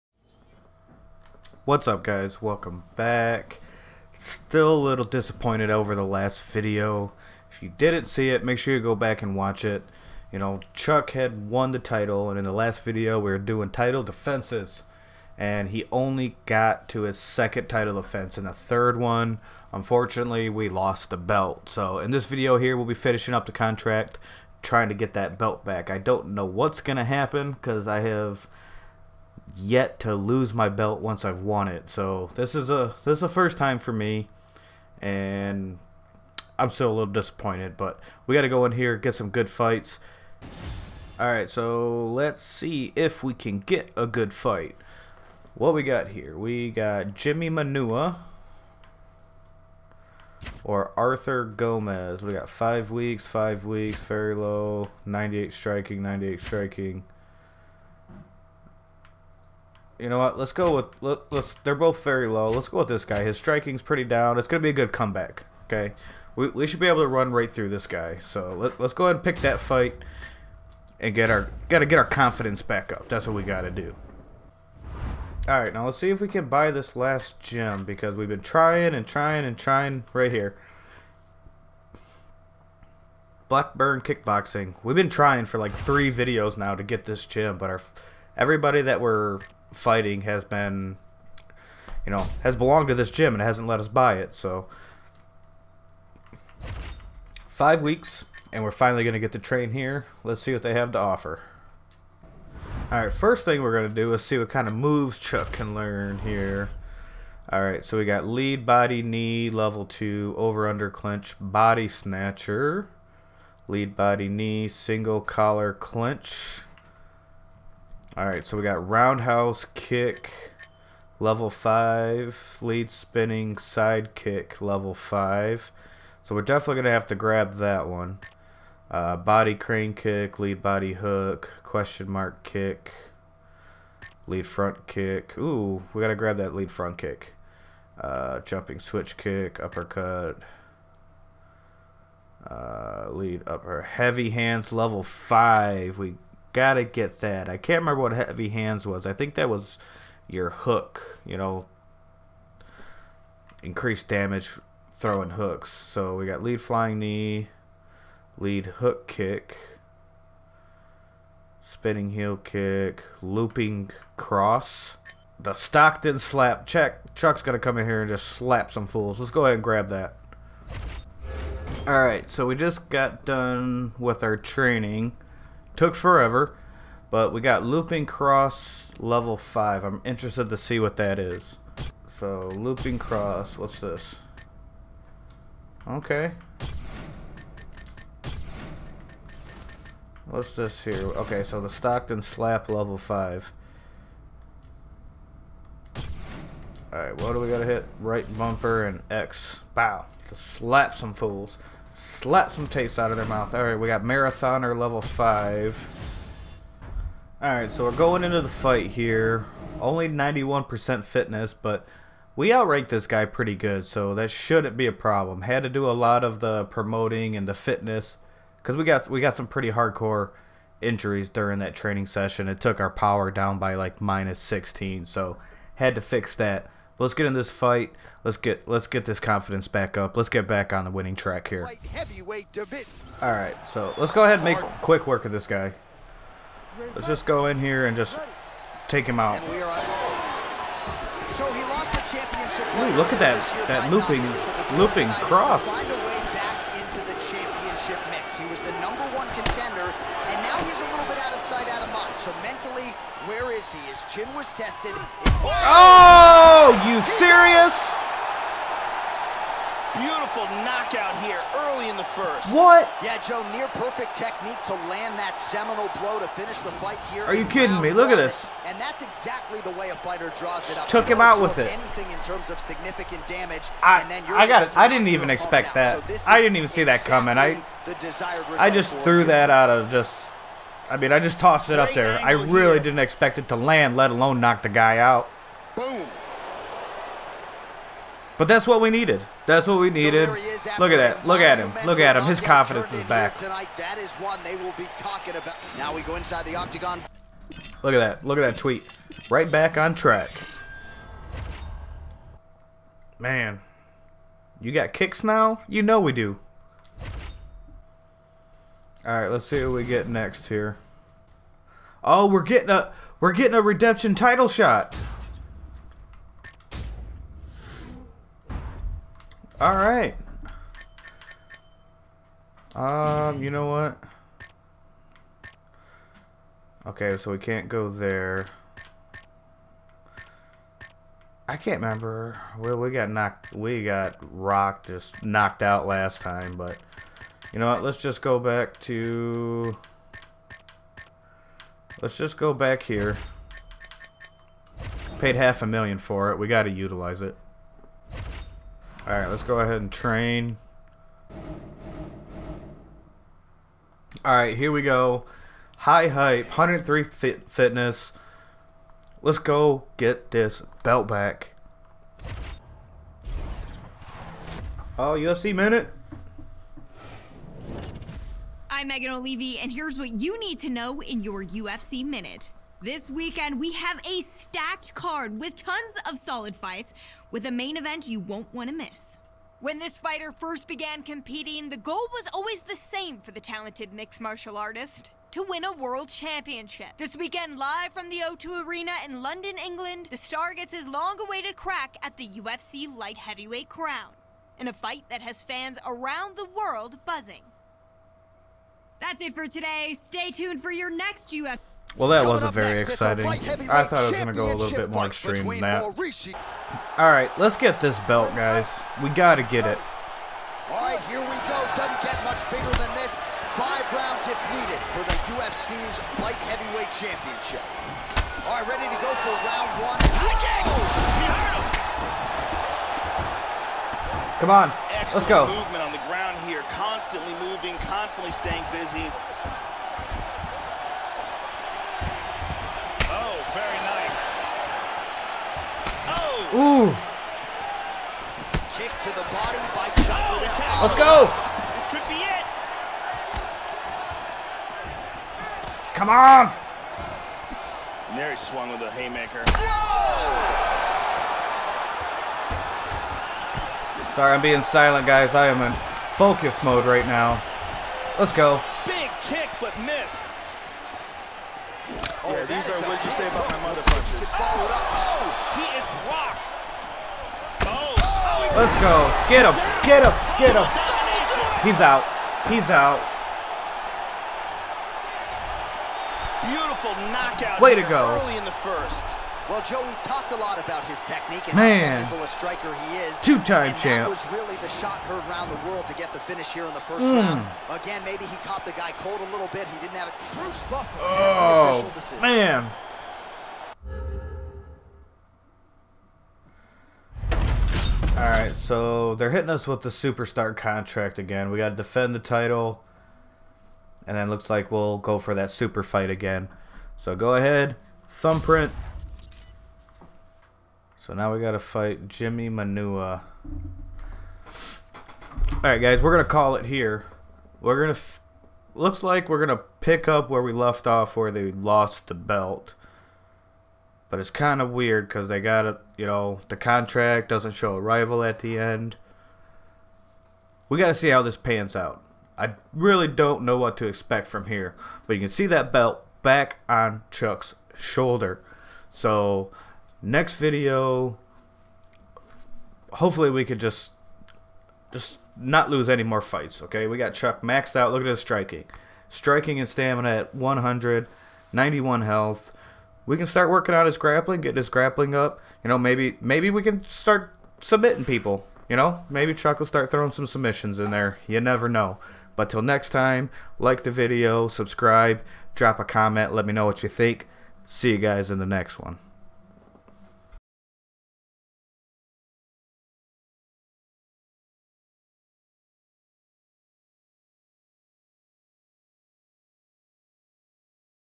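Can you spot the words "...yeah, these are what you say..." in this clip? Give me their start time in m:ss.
7:42.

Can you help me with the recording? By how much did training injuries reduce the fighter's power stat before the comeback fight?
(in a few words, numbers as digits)
16.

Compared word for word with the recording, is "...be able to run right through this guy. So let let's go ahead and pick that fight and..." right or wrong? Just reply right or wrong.
right.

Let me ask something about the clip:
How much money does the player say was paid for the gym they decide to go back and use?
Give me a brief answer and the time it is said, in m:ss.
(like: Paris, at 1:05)
Half a million, at 5:45.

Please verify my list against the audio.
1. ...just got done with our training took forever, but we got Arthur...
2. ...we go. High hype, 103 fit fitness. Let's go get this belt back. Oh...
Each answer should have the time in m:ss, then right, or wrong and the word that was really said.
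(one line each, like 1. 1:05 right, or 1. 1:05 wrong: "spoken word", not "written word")
1. 2:52 wrong: "Looping", not "Arthur"
2. 5:54 right.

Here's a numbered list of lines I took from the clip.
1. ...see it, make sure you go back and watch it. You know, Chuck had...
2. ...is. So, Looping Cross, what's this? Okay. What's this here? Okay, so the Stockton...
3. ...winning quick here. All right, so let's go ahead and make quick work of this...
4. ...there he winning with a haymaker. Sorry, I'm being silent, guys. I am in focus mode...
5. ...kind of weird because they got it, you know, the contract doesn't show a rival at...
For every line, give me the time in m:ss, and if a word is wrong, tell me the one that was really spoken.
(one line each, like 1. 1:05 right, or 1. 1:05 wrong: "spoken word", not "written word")
1. 0:08 right
2. 3:01 right
3. 3:50 wrong: "track", not "quick"
4. 7:28 wrong: "swung", not "winning"
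5. 8:44 right.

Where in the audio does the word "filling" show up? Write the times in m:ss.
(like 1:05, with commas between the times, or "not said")
not said.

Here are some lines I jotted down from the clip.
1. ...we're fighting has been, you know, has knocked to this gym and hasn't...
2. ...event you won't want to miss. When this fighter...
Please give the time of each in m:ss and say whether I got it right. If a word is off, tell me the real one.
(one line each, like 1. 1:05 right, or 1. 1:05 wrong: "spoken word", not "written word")
1. 1:28 wrong: "belonged", not "knocked"
2. 6:17 right.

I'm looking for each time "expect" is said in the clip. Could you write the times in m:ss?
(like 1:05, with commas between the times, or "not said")
4:35, 4:42, 8:53.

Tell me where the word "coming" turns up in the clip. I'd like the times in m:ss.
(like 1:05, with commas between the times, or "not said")
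4:37, 6:42.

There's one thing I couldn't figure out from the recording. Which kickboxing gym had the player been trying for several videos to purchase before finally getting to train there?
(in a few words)
Blackburn Kickboxing.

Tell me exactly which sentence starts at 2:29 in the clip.
I think that was your hook, you know, increased damage throwing hooks.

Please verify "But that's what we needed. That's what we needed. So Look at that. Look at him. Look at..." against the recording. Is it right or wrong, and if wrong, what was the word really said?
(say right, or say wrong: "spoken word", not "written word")
right.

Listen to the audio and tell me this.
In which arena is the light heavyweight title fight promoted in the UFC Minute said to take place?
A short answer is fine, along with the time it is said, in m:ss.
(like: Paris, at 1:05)
The O2 Arena, at 6:28.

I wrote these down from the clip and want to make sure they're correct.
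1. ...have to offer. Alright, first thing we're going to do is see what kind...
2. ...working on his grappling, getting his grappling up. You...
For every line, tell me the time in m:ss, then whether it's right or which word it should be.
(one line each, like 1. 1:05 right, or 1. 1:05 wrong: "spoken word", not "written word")
1. 1:40 right
2. 9:13 right.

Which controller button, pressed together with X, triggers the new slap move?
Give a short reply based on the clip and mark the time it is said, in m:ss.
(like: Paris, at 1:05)
Right bumper, at 3:17.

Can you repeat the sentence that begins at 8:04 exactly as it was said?
was really the shot heard round the world to get the finish here in the first mm.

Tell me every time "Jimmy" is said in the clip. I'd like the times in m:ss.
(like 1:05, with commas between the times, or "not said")
0:47, 8:32.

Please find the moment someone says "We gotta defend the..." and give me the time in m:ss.
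8:21.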